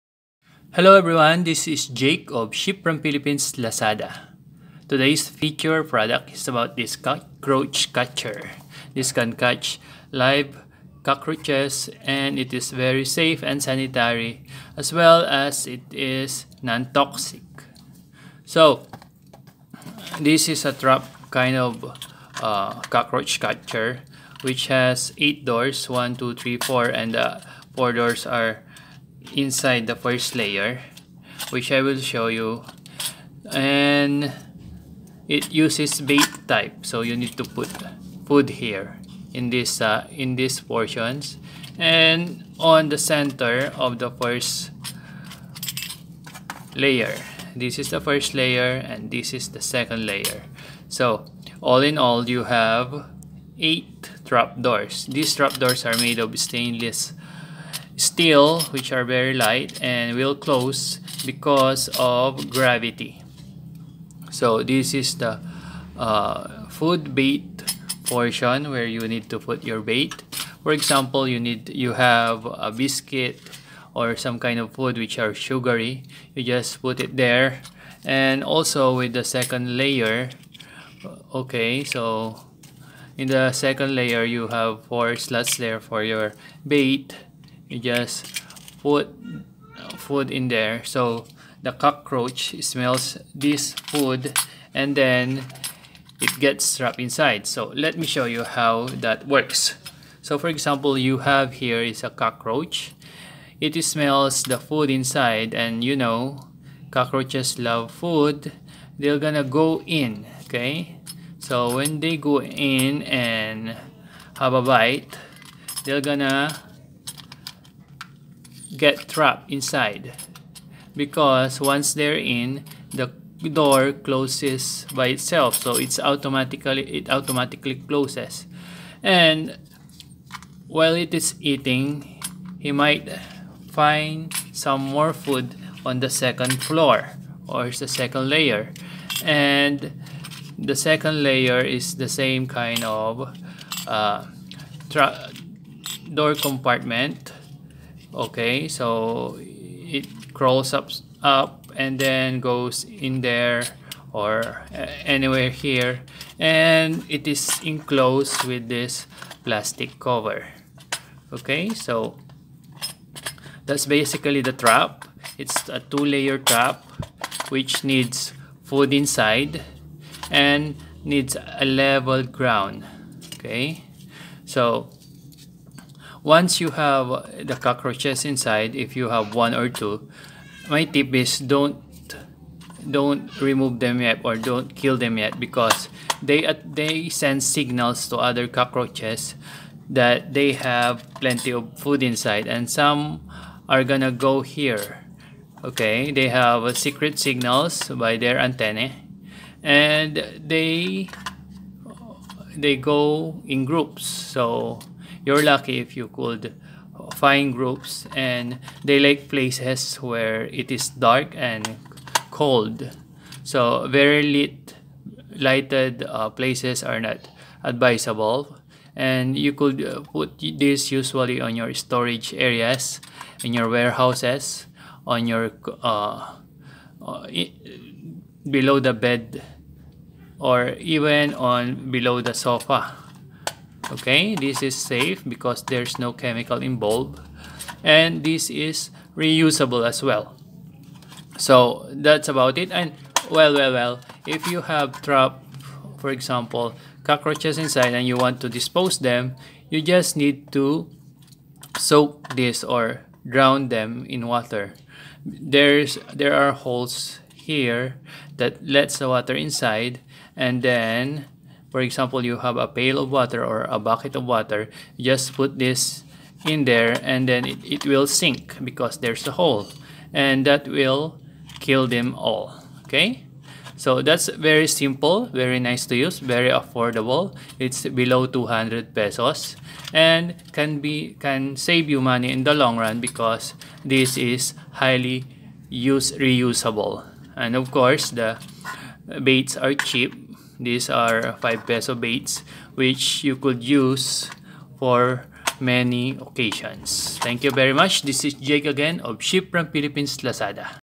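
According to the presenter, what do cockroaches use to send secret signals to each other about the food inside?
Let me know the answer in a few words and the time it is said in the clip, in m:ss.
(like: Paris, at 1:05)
antennae, at 3:18.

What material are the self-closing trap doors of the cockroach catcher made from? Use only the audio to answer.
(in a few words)
stainless steel.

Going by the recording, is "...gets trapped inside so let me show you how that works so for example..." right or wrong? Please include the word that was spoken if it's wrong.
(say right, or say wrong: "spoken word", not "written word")
right.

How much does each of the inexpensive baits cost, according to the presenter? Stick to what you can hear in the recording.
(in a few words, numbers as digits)
5 pesos.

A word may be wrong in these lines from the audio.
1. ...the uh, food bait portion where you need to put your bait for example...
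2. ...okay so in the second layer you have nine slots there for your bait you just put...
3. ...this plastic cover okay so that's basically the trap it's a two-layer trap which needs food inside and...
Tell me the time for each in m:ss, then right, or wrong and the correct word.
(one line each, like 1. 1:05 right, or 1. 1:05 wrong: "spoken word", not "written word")
1. 1:05 right
2. 1:21 wrong: "four", not "nine"
3. 2:38 right.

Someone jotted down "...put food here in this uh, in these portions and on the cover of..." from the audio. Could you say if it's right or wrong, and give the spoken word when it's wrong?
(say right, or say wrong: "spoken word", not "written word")
wrong: "center", not "cover".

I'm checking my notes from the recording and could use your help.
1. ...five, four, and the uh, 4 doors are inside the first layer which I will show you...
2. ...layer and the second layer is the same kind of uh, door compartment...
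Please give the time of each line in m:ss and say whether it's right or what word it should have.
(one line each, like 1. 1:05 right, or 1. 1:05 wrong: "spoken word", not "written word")
1. 0:26 wrong: "three", not "five"
2. 2:18 right.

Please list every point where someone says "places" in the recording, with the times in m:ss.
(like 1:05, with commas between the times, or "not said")
3:29, 3:36.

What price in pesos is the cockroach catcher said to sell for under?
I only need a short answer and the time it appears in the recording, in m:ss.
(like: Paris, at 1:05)
200 pesos, at 4:38.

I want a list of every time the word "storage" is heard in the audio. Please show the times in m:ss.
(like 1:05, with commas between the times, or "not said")
3:41.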